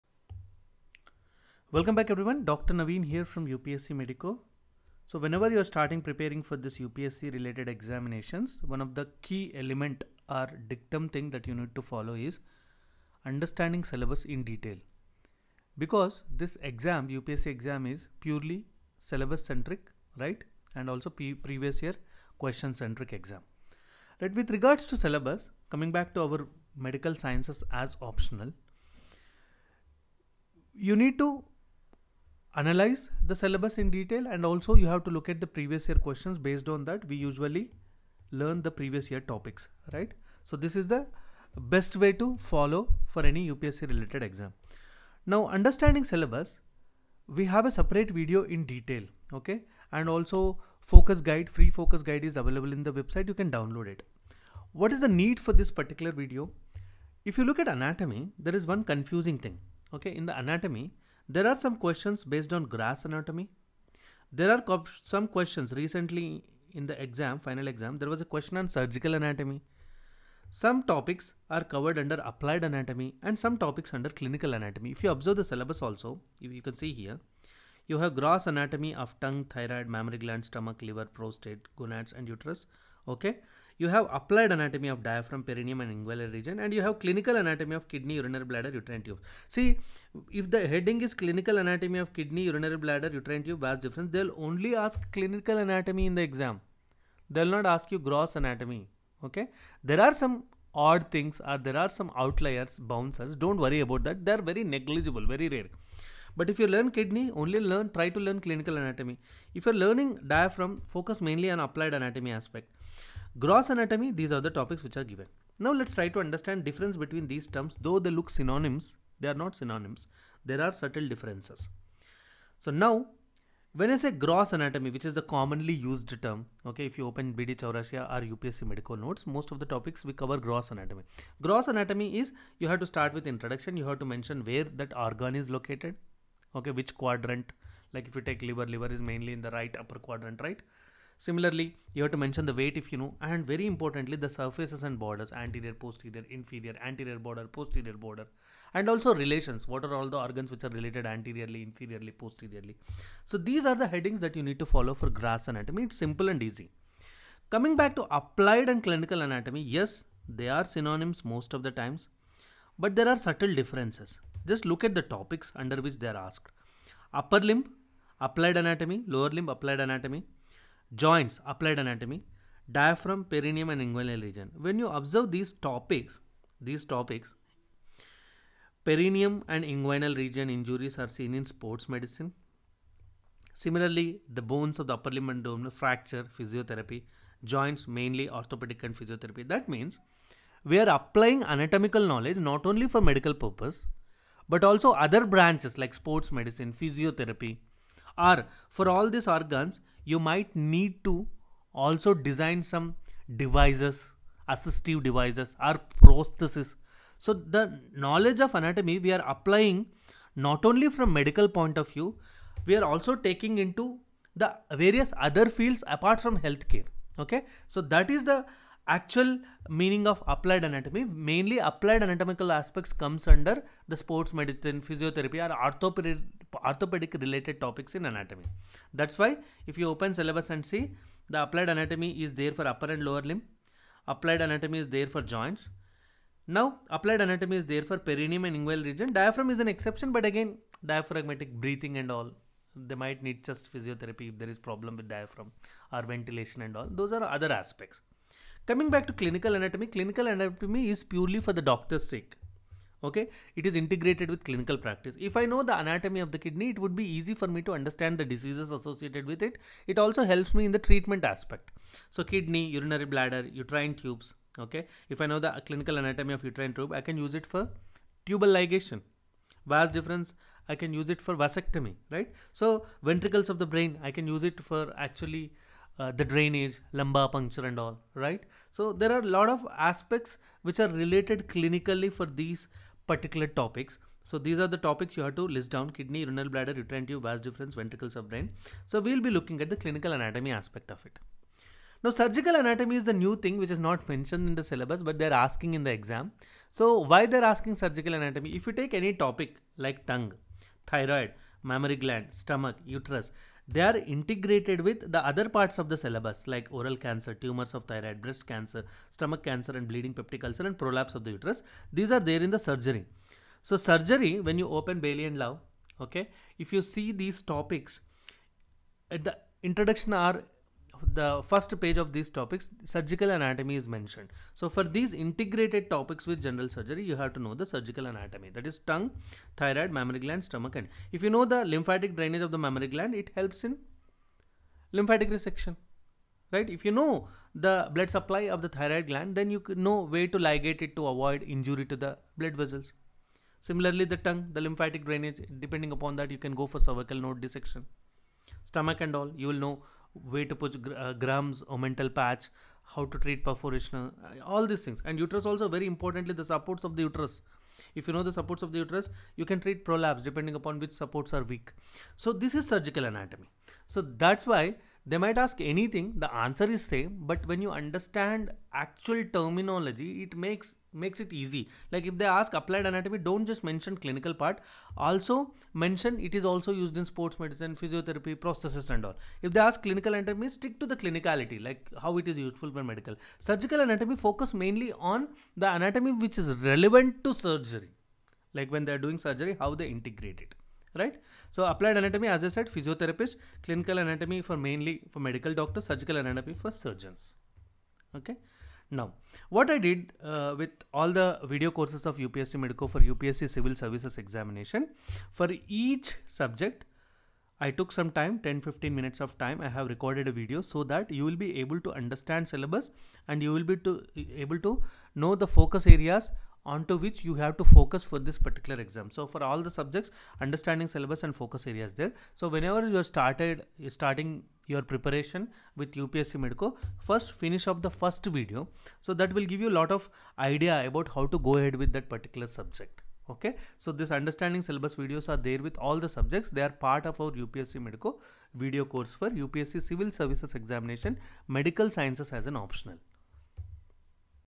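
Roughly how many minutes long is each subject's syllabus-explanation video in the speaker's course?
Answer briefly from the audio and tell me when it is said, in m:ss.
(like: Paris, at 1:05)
10-15 minutes, at 6:48.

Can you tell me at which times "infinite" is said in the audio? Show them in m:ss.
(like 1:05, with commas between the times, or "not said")
not said.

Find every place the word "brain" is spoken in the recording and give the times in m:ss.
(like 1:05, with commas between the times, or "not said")
4:33, 4:48.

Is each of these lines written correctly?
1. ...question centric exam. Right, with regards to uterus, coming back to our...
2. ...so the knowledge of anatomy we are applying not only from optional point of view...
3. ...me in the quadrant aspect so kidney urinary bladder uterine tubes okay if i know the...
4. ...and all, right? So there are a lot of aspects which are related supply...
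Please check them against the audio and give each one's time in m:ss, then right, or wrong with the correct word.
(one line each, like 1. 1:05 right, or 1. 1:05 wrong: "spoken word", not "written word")
1. 0:22 wrong: "syllabus", not "uterus"
2. 3:27 wrong: "medical", not "optional"
3. 4:20 wrong: "treatment", not "quadrant"
4. 4:37 wrong: "clinically", not "supply".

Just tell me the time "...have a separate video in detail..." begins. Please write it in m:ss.
0:47.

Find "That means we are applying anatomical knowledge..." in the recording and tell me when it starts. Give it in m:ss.
3:09.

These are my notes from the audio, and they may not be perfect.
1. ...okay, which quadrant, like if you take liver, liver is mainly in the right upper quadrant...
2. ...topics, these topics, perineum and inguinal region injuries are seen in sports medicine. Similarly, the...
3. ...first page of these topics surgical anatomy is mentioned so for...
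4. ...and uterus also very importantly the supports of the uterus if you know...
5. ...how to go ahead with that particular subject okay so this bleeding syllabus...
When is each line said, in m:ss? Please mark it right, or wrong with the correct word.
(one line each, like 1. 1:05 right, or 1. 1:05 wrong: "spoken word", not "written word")
1. 2:16 right
2. 2:55 right
3. 5:21 right
4. 5:55 right
5. 7:11 wrong: "understanding", not "bleeding".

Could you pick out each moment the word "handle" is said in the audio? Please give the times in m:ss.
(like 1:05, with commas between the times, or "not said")
not said.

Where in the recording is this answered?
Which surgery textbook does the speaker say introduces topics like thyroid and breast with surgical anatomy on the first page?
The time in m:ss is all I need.
5:14.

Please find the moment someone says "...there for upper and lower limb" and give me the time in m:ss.
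3:52.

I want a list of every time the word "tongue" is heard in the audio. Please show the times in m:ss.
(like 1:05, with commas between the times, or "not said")
1:19, 5:00, 5:28, 5:44.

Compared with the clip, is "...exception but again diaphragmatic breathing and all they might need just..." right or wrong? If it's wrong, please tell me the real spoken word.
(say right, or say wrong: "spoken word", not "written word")
right.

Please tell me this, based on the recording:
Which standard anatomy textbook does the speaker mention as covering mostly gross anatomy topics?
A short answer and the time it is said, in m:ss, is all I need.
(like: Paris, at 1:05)
BD Chaurasia, at 2:07.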